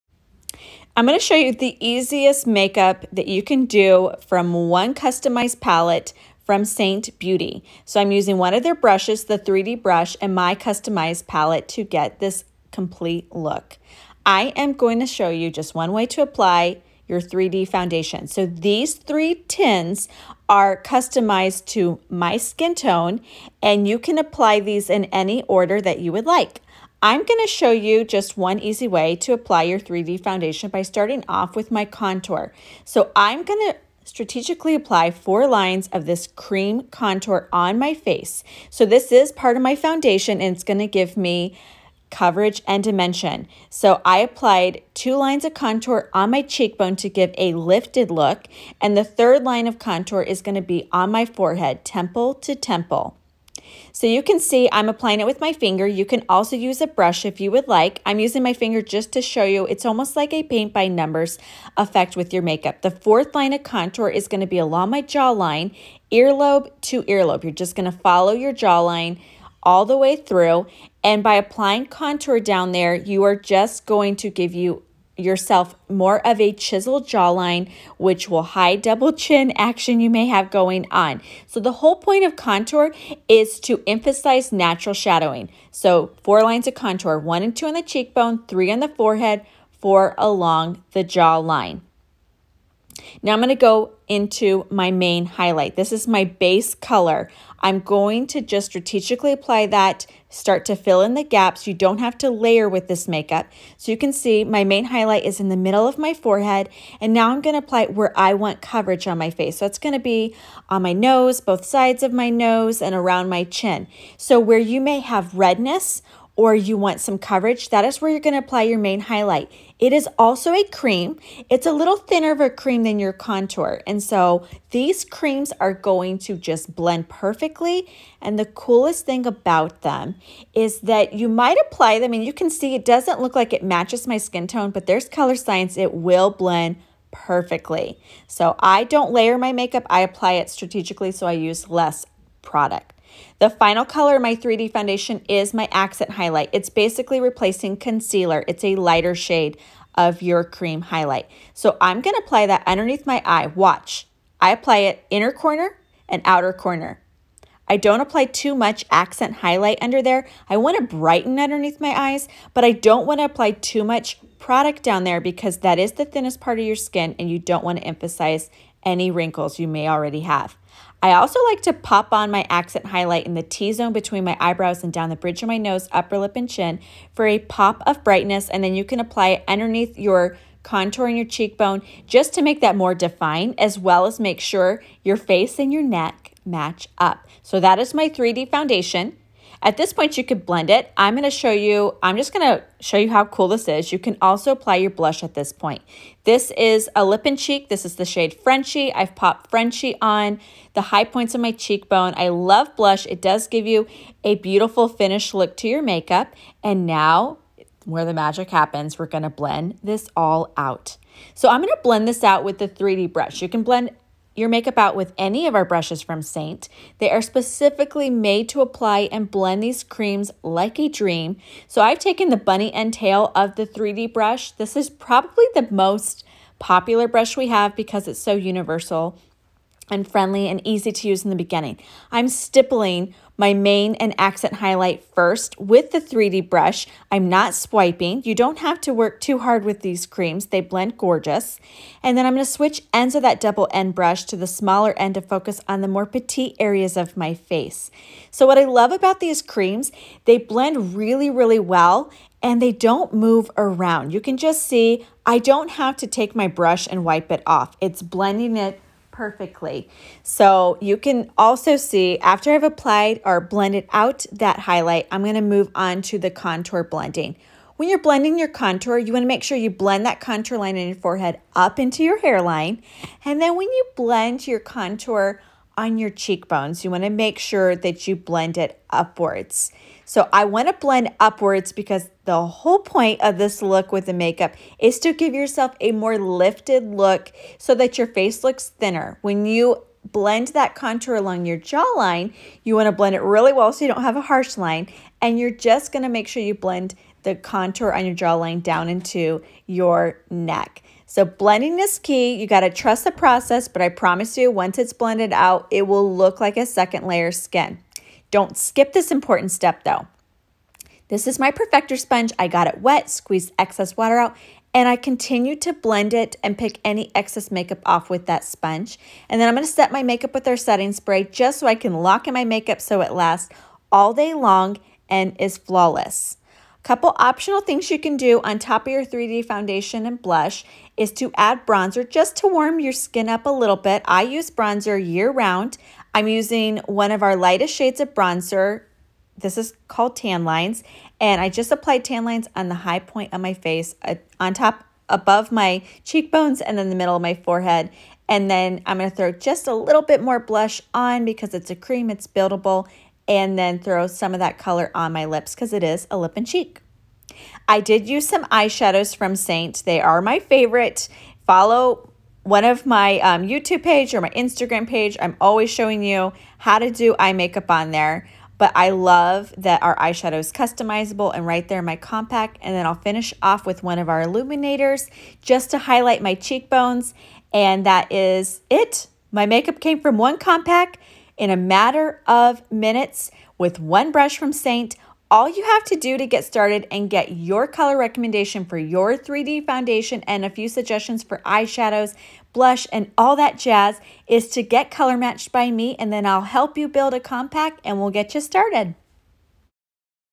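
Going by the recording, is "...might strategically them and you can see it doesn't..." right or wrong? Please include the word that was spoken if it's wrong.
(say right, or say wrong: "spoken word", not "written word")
wrong: "apply", not "strategically".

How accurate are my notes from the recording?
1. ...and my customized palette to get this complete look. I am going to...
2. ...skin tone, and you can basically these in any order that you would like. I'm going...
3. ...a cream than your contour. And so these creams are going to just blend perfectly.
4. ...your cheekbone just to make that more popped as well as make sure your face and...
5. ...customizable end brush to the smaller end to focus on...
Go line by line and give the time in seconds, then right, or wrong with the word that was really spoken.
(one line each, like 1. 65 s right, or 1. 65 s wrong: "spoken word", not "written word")
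1. 10 s right
2. 22 s wrong: "apply", not "basically"
3. 122 s right
4. 181 s wrong: "defined", not "popped"
5. 243 s wrong: "double", not "customizable".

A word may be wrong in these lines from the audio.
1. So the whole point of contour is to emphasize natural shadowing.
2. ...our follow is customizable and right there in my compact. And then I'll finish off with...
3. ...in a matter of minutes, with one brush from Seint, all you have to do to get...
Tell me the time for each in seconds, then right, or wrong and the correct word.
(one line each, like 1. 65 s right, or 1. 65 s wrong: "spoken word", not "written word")
1. 81 s right
2. 369 s wrong: "eyeshadow", not "follow"
3. 381 s right.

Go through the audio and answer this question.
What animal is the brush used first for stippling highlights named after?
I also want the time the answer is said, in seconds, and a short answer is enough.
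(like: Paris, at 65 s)
bunny, at 222 s.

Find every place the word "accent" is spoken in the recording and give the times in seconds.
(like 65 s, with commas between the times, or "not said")
145 s, 158 s, 172 s, 234 s.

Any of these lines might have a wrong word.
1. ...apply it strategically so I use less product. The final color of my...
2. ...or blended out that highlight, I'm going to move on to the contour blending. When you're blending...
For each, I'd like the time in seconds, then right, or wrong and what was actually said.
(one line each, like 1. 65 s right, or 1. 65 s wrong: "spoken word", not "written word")
1. 140 s right
2. 263 s right.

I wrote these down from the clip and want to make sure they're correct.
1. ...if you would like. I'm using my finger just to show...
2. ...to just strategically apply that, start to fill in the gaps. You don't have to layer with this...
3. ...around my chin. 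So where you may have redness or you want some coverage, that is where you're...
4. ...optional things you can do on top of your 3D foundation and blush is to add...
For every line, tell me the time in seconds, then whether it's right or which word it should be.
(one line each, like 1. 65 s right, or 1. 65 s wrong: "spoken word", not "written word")
1. 57 s right
2. 98 s right
3. 112 s right
4. 327 s right.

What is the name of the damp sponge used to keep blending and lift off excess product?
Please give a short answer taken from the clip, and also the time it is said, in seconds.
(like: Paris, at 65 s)
perfector sponge, at 311 s.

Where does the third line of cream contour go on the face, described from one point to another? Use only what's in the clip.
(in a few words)
temple to temple.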